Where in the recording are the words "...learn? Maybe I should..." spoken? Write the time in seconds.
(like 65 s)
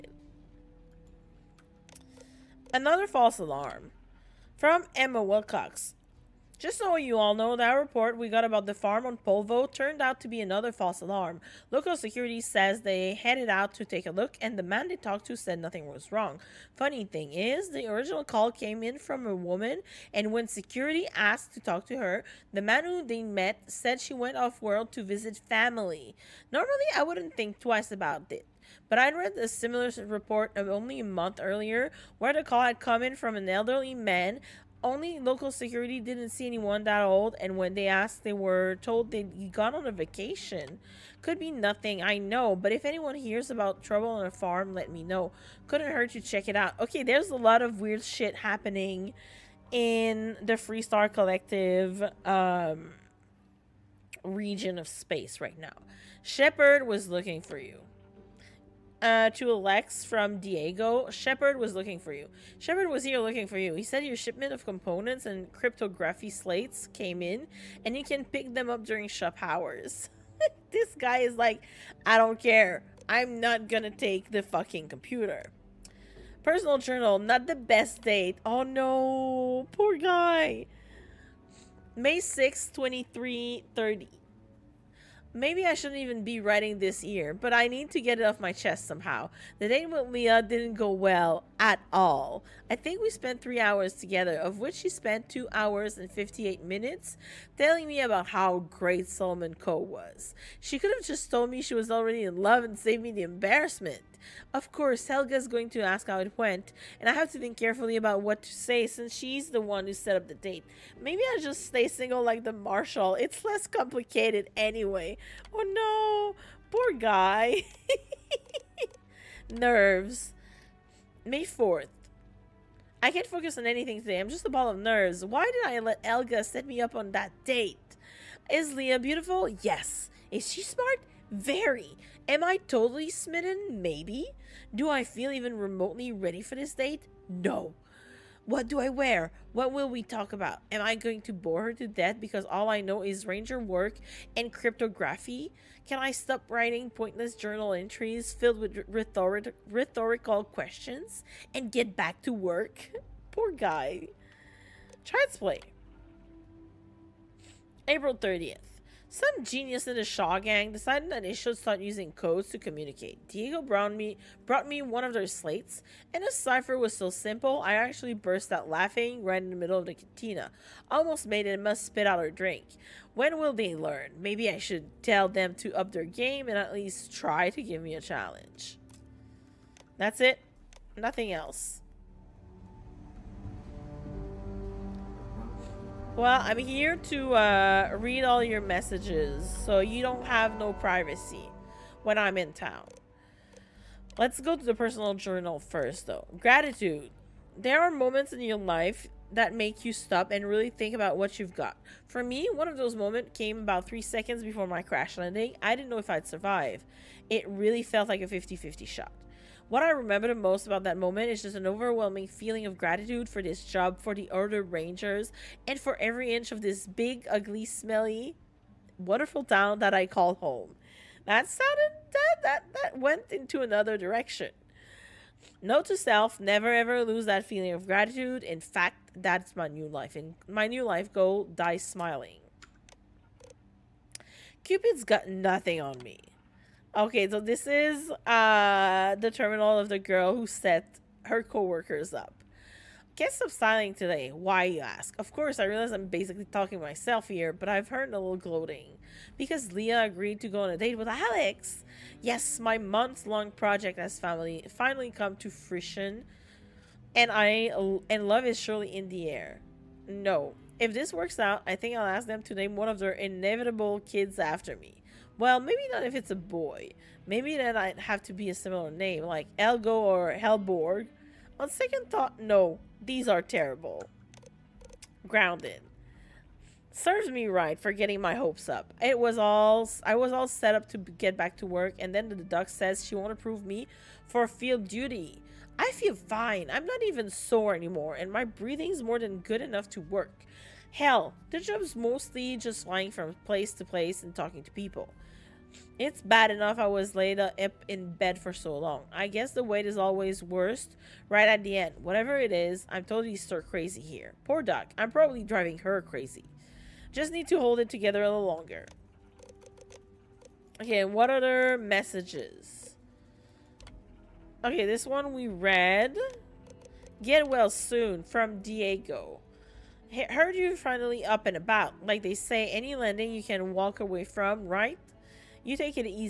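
173 s.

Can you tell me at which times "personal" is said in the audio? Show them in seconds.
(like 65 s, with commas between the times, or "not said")
76 s, 194 s.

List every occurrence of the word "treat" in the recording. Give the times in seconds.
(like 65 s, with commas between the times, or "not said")
not said.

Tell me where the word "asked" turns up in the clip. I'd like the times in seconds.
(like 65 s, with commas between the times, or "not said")
21 s, 37 s.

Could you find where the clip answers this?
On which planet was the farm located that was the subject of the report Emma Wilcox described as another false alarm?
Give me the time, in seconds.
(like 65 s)
9 s.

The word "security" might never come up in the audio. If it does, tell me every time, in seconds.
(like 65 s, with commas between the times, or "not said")
11 s, 20 s, 35 s.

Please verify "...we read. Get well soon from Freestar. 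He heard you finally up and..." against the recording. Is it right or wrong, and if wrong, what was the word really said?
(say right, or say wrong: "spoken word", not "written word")
wrong: "Diego", not "Freestar".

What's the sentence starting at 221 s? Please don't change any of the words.
That sounded that that that went into another direction.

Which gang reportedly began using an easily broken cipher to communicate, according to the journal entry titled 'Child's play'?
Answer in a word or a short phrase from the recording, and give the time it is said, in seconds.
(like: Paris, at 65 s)
The Shaw gang, at 160 s.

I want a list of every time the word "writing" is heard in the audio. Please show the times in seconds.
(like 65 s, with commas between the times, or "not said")
86 s, 146 s.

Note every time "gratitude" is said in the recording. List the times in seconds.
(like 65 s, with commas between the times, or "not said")
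196 s, 212 s, 227 s.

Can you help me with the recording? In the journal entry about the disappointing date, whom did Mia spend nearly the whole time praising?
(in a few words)
Solomon Coe.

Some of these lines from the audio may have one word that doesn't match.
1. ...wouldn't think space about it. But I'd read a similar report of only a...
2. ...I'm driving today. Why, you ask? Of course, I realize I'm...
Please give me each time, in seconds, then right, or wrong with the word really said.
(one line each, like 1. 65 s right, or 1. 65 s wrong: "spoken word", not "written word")
1. 27 s wrong: "twice", not "space"
2. 243 s wrong: "styling", not "driving".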